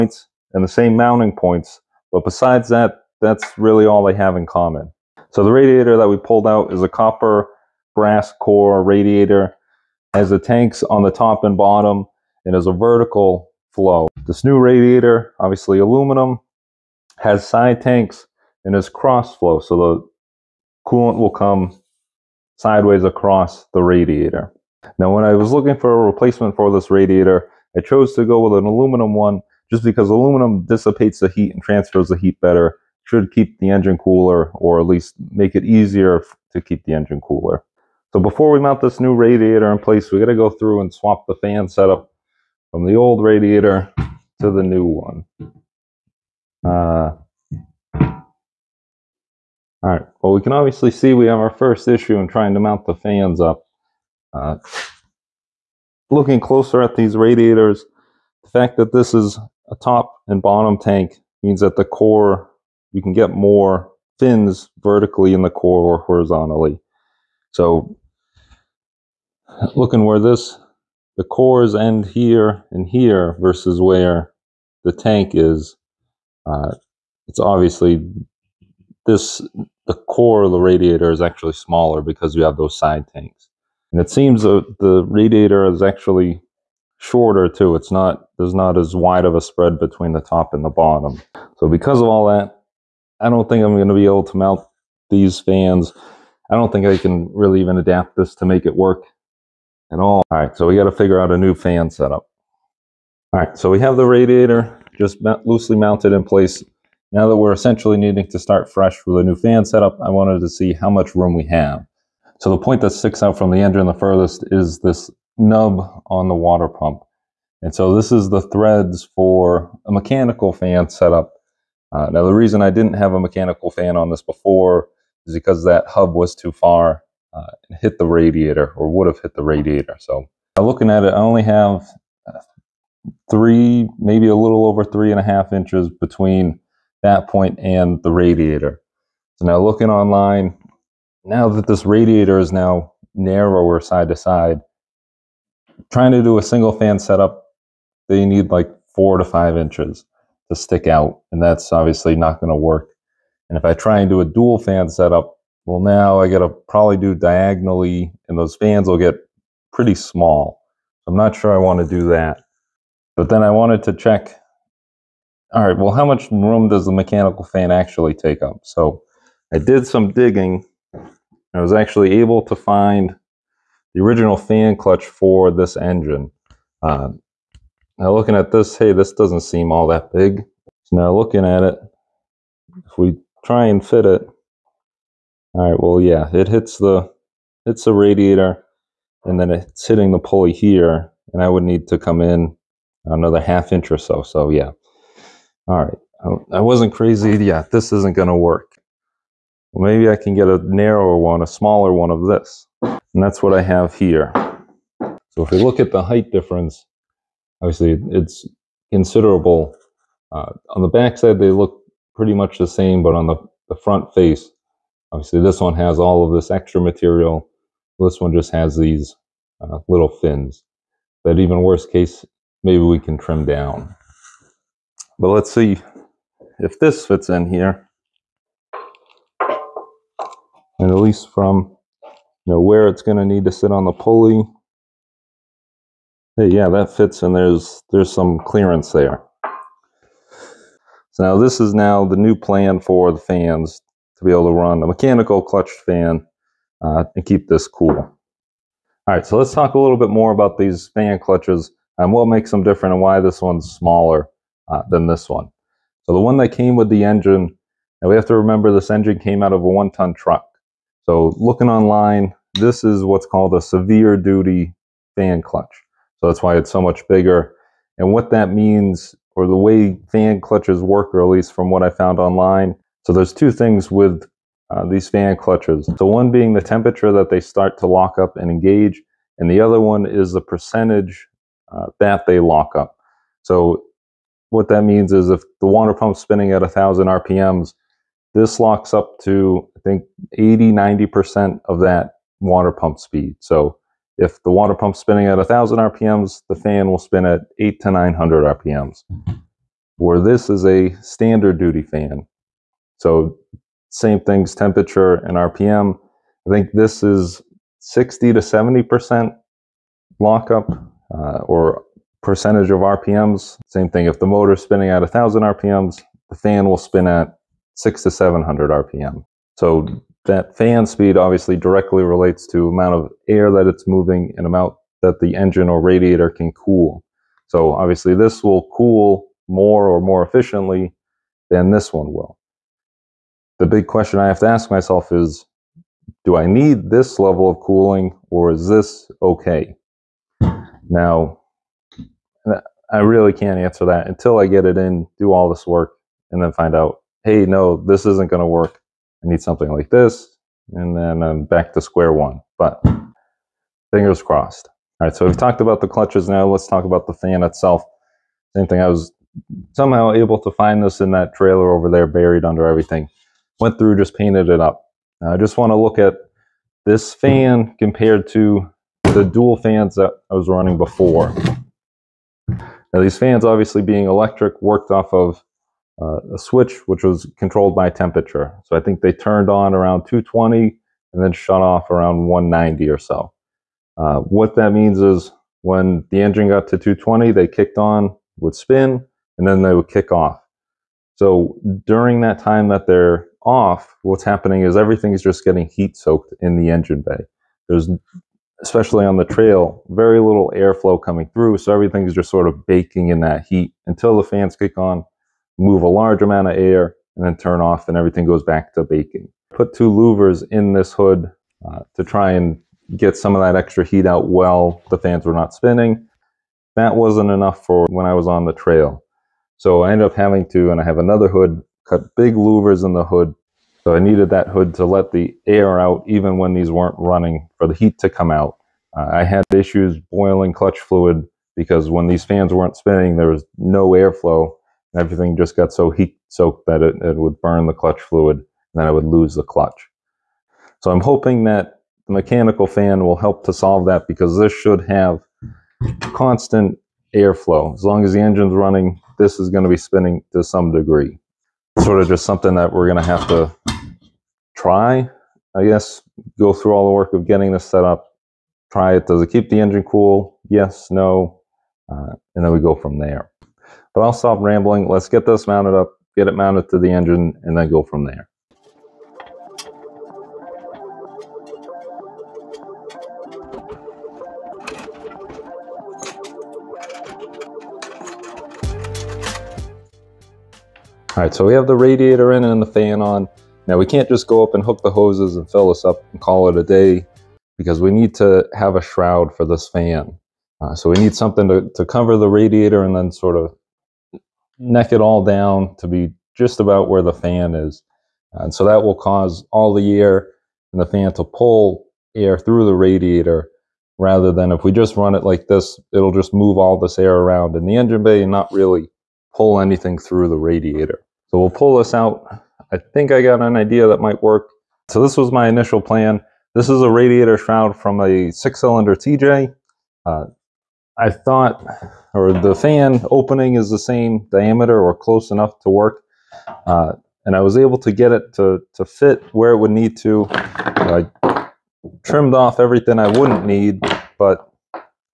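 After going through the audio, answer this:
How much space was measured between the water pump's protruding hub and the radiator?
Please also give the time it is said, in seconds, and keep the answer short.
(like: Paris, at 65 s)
3.5 inches, at 134 s.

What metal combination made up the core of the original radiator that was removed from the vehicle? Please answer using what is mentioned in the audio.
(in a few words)
Copper brass.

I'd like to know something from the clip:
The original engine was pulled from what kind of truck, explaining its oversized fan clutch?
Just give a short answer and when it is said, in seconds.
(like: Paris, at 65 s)
One-ton truck, at 259 s.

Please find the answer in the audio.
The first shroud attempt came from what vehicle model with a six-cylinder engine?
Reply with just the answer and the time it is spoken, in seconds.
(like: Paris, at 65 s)
TJ, at 518 s.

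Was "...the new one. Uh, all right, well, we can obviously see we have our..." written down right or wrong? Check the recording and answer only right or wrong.
right.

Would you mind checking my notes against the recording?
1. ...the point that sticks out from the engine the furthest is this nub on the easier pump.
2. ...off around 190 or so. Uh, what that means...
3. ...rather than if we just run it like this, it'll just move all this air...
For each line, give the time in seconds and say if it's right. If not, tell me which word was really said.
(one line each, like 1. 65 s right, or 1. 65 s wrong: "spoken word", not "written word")
1. 112 s wrong: "water", not "easier"
2. 381 s right
3. 503 s right.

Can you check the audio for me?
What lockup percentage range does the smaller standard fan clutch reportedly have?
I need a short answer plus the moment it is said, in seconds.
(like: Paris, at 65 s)
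60 to 70%, at 307 s.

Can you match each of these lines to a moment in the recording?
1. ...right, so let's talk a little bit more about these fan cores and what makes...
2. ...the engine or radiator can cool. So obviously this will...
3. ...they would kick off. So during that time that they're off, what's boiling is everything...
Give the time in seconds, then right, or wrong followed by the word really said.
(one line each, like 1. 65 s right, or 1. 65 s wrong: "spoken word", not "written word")
1. 249 s wrong: "clutches", not "cores"
2. 325 s right
3. 389 s wrong: "happening", not "boiling".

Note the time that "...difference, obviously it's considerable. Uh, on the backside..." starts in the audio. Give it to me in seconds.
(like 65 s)
206 s.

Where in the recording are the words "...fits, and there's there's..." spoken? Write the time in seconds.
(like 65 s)
236 s.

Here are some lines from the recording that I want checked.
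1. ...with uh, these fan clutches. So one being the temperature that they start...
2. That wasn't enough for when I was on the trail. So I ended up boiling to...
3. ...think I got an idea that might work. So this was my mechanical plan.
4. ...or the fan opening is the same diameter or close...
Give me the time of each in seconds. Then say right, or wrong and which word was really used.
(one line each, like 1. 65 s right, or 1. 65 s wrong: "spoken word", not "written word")
1. 273 s right
2. 416 s wrong: "having", not "boiling"
3. 512 s wrong: "initial", not "mechanical"
4. 522 s right.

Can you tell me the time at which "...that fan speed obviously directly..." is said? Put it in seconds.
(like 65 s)
320 s.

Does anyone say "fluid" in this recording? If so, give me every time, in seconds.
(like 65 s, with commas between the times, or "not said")
430 s, 438 s.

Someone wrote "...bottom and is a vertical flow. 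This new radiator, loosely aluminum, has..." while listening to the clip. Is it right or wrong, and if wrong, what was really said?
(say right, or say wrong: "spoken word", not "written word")
wrong: "obviously", not "loosely".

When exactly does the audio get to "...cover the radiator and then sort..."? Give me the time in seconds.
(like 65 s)
491 s.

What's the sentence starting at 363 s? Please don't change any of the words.
Went through, just painted it up.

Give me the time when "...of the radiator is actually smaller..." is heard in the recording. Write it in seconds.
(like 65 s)
80 s.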